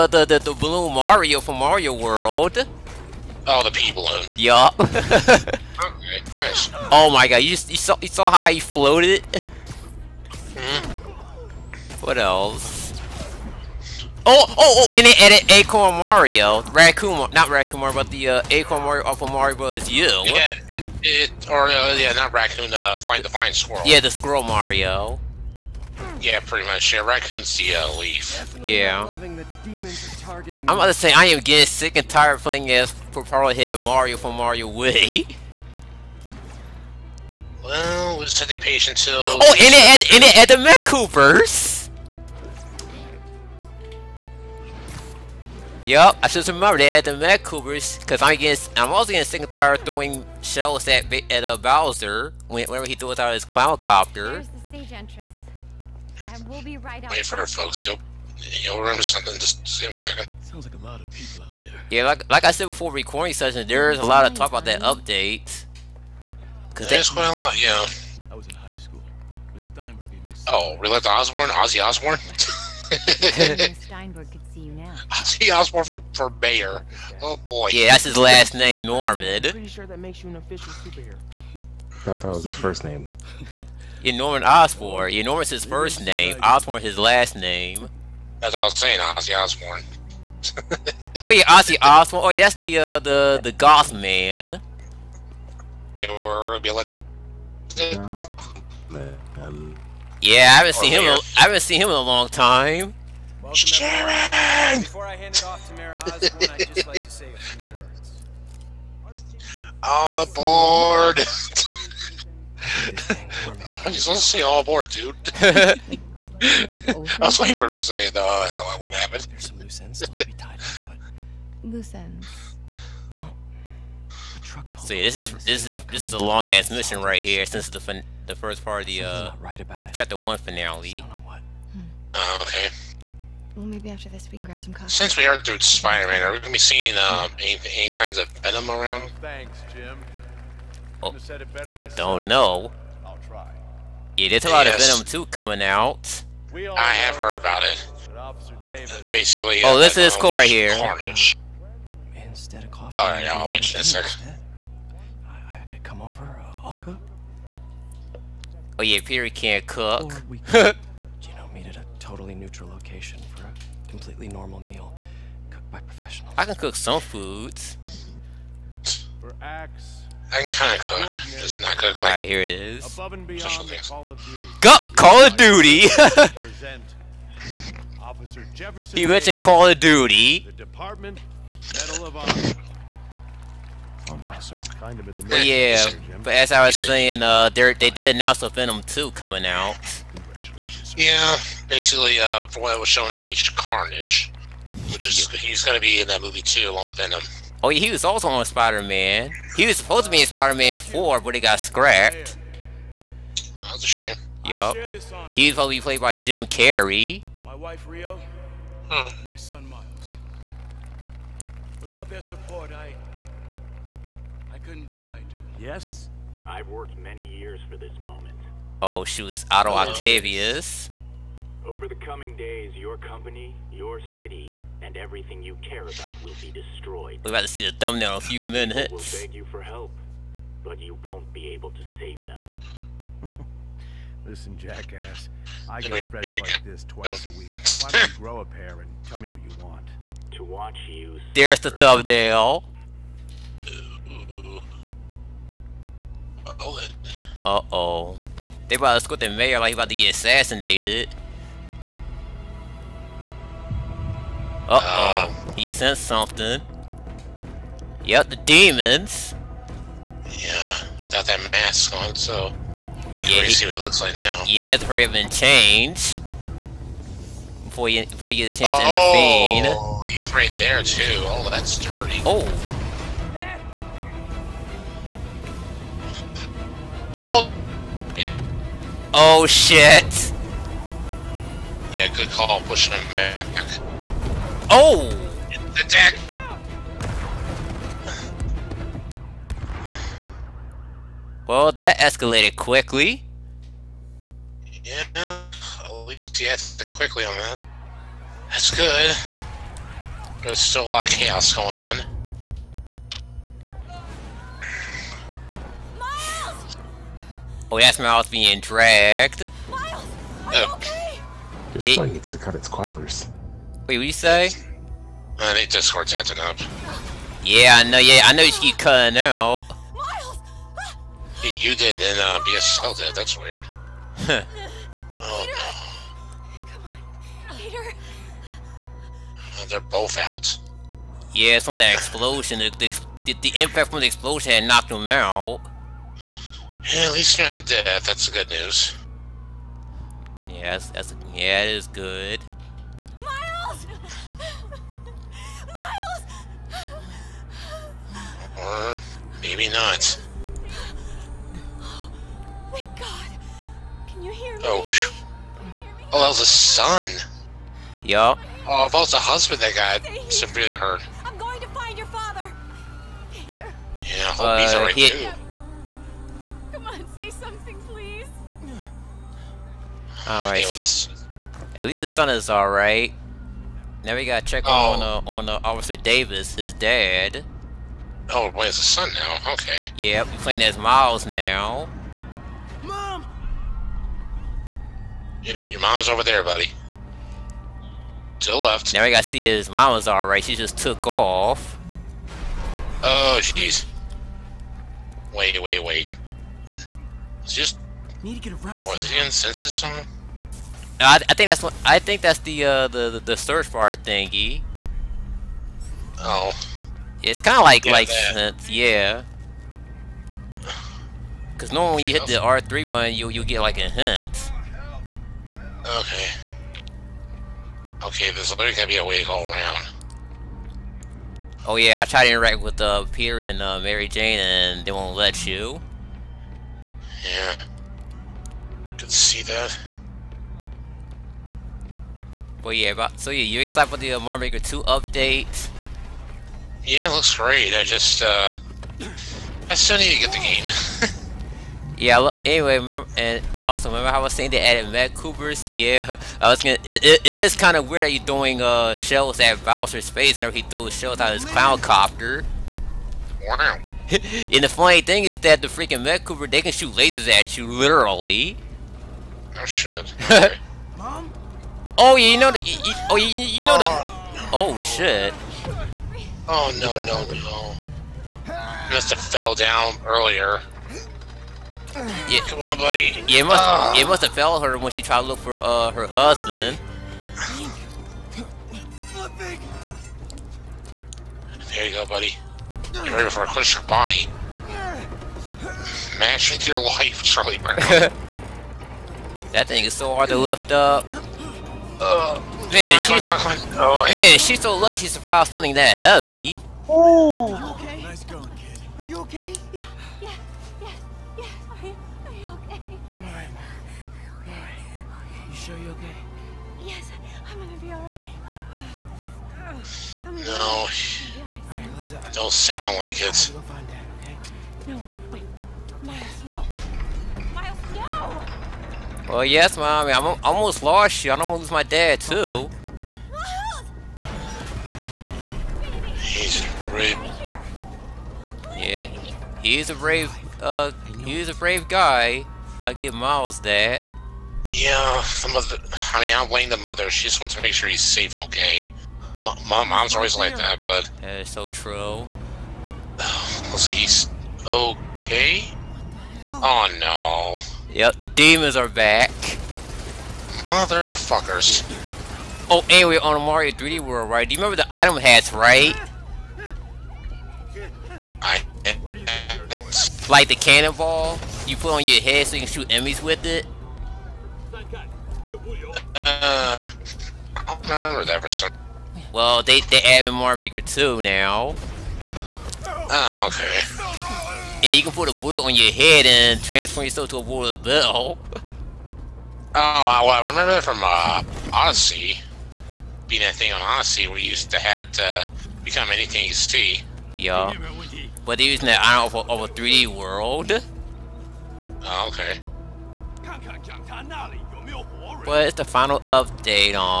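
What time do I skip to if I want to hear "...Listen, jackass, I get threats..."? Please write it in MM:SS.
03:54.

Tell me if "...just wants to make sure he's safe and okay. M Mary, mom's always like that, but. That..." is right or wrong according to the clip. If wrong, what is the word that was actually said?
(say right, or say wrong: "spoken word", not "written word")
wrong: "Mom", not "Mary".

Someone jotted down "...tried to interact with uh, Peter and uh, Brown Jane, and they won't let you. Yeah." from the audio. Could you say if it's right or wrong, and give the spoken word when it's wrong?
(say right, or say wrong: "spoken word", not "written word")
wrong: "Mary", not "Brown".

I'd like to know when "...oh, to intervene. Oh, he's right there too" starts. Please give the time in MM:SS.
04:28.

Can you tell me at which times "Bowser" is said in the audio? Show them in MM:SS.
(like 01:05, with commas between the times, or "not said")
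00:51, 07:29.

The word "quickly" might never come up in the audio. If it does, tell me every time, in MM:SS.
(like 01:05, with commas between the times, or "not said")
04:52, 04:56.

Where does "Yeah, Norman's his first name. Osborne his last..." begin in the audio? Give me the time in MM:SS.
01:25.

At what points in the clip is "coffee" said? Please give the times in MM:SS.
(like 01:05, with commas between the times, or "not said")
02:14, 02:32.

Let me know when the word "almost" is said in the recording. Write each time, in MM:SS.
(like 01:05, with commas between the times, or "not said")
08:40.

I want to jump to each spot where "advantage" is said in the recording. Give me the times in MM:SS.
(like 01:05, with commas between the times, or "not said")
not said.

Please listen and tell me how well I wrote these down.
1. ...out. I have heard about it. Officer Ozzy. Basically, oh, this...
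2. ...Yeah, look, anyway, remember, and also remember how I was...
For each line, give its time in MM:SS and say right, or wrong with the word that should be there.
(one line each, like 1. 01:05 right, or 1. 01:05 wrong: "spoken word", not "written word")
1. 02:25 wrong: "Davis", not "Ozzy"
2. 07:21 right.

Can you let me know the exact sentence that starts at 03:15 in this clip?
he's gonna be in that movie too, along with Venom.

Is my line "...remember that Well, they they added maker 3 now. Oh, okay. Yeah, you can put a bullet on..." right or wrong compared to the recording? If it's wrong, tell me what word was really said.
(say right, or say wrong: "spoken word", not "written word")
wrong: "2", not "3".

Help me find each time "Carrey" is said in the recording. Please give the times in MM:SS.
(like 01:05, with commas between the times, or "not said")
03:26.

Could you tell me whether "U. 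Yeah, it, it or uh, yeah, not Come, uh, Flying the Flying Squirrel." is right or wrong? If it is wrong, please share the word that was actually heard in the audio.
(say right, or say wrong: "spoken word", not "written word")
wrong: "Raccoon", not "Come".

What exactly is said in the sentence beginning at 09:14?
Do you remember the item hats, right?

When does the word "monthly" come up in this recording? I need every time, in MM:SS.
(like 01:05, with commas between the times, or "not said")
not said.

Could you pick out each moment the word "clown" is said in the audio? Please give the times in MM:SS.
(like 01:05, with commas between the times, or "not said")
00:53, 07:31.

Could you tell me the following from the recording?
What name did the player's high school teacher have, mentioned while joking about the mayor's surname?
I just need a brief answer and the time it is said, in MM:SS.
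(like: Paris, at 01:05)
Miss Steinberg, at 01:09.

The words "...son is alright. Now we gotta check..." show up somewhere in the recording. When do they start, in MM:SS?
06:12.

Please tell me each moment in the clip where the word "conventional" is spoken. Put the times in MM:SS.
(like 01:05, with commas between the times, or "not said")
not said.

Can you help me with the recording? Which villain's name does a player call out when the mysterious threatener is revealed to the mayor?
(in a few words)
Otto Octavius.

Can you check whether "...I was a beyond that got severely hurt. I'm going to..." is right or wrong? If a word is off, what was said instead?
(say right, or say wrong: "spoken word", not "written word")
wrong: "husband", not "beyond".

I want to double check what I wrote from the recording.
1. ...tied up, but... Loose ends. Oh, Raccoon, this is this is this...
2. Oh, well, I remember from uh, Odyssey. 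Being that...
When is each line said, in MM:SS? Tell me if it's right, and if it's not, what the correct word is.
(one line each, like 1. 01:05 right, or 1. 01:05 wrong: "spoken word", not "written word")
1. 02:00 wrong: "See", not "Raccoon"
2. 09:39 right.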